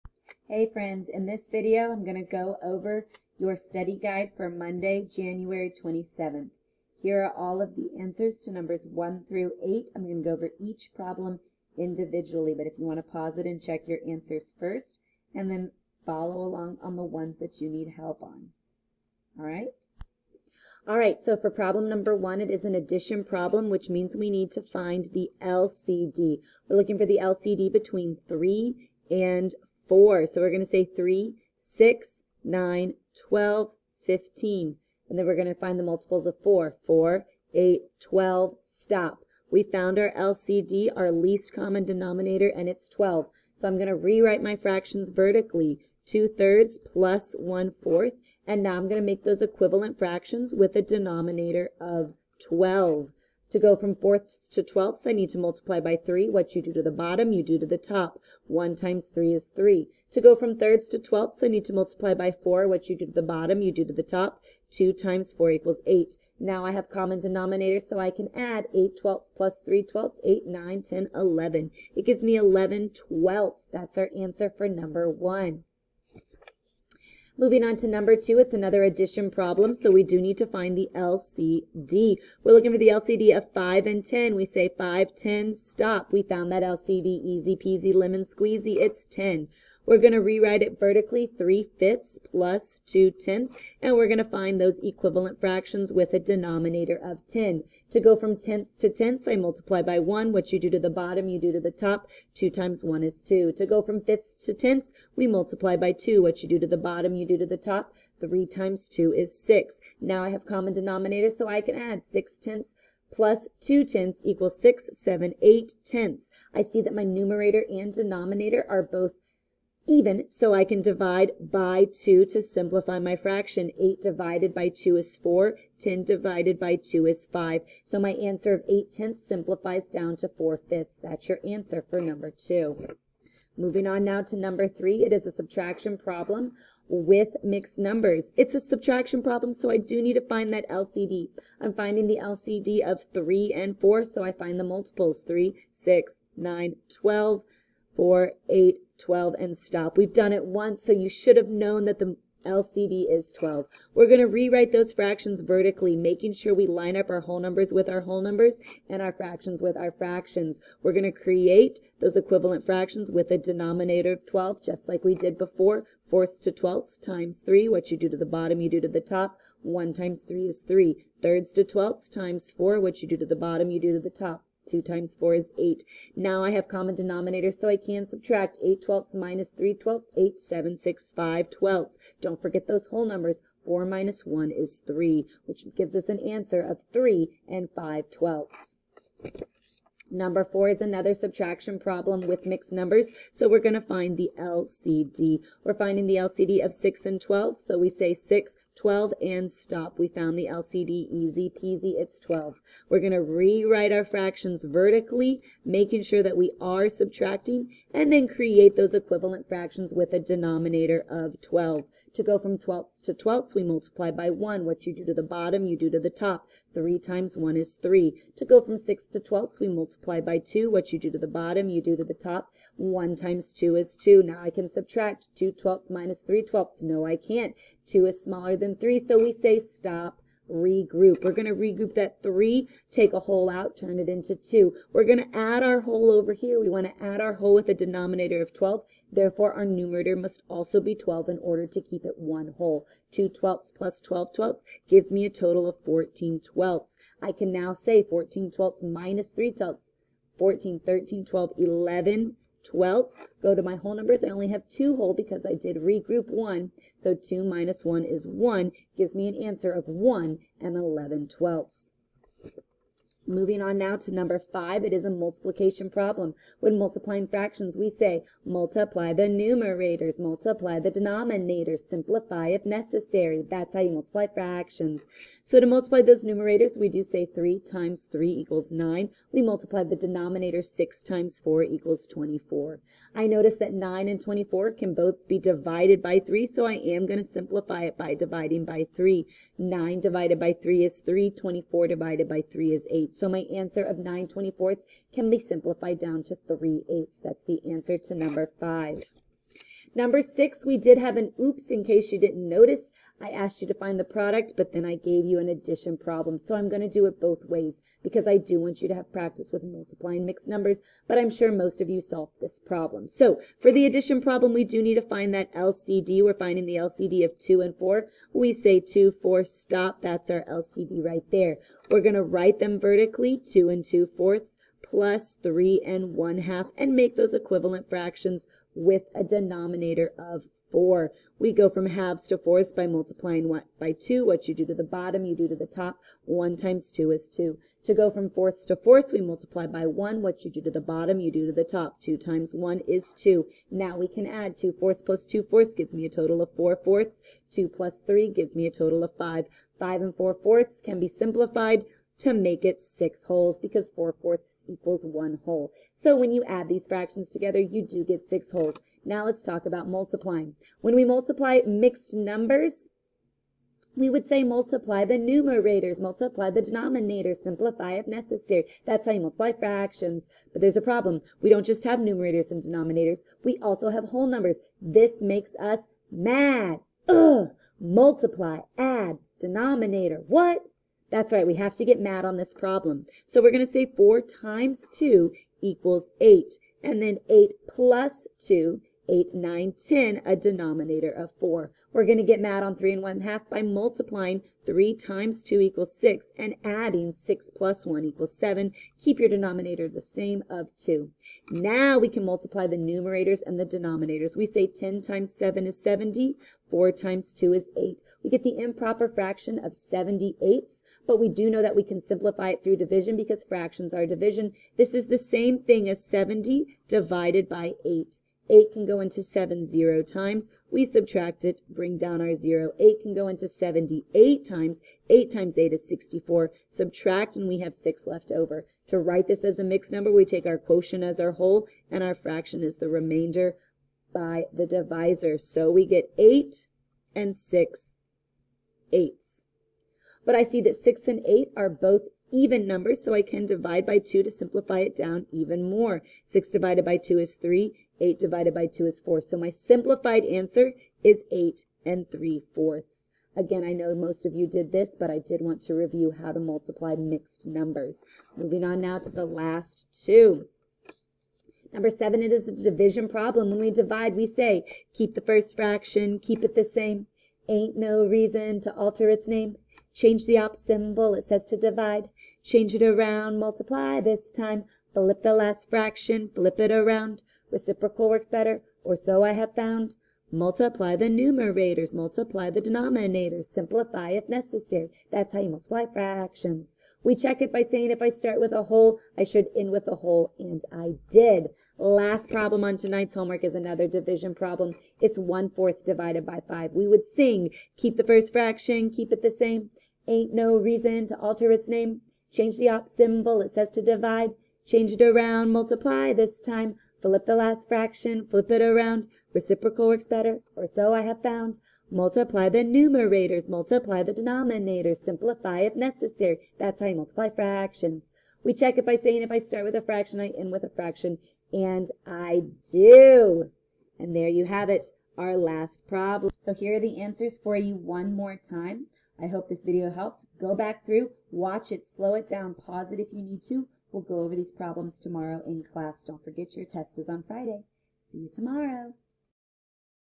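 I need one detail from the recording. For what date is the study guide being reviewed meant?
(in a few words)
Monday, January 27th.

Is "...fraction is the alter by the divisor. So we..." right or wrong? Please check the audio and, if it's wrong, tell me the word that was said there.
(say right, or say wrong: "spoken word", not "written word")
wrong: "remainder", not "alter".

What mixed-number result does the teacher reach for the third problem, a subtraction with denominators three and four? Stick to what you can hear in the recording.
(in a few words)
3 5/12.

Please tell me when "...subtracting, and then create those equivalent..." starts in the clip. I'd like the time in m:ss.
3:26.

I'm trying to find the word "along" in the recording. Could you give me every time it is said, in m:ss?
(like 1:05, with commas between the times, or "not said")
0:16.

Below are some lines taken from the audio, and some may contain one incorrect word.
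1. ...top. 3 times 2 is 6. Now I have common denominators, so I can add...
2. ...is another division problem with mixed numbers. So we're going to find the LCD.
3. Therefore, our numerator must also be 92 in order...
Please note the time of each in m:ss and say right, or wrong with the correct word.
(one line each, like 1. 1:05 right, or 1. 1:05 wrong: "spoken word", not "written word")
1. 1:47 right
2. 3:10 wrong: "subtraction", not "division"
3. 3:59 wrong: "12", not "92".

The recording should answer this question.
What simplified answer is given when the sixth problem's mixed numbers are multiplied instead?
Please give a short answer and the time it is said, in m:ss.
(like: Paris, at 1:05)
8 3/4, at 7:31.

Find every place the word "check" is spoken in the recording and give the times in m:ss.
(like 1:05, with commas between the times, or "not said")
0:13, 8:07, 8:38.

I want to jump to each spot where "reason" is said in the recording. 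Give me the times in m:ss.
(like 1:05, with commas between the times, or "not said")
7:48, 8:20.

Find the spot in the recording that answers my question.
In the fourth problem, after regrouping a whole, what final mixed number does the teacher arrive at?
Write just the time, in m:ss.
4:19.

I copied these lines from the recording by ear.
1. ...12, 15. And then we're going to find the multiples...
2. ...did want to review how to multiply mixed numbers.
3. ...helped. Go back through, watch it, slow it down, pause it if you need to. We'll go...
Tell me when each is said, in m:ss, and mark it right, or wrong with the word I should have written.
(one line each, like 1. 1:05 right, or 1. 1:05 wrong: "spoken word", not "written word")
1. 0:33 right
2. 7:35 right
3. 8:49 right.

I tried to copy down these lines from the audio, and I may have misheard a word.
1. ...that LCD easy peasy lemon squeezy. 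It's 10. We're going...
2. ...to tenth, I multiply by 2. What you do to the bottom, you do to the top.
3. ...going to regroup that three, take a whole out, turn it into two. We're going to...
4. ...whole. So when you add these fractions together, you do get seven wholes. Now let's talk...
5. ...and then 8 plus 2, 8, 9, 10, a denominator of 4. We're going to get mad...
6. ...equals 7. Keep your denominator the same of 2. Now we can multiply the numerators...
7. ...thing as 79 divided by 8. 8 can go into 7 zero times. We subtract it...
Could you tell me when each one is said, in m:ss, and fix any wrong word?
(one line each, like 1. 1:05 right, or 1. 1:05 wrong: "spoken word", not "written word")
1. 1:26 right
2. 1:38 wrong: "1", not "2"
3. 3:51 right
4. 5:55 wrong: "six", not "seven"
5. 6:26 right
6. 6:38 right
7. 6:55 wrong: "70", not "79".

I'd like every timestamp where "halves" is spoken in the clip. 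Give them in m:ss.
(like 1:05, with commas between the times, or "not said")
5:31.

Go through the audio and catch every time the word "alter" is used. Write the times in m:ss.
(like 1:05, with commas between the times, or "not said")
7:48, 8:21.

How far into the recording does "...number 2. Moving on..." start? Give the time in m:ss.
2:11.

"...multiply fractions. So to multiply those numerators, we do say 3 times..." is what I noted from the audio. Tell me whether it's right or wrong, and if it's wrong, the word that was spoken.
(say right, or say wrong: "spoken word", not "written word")
right.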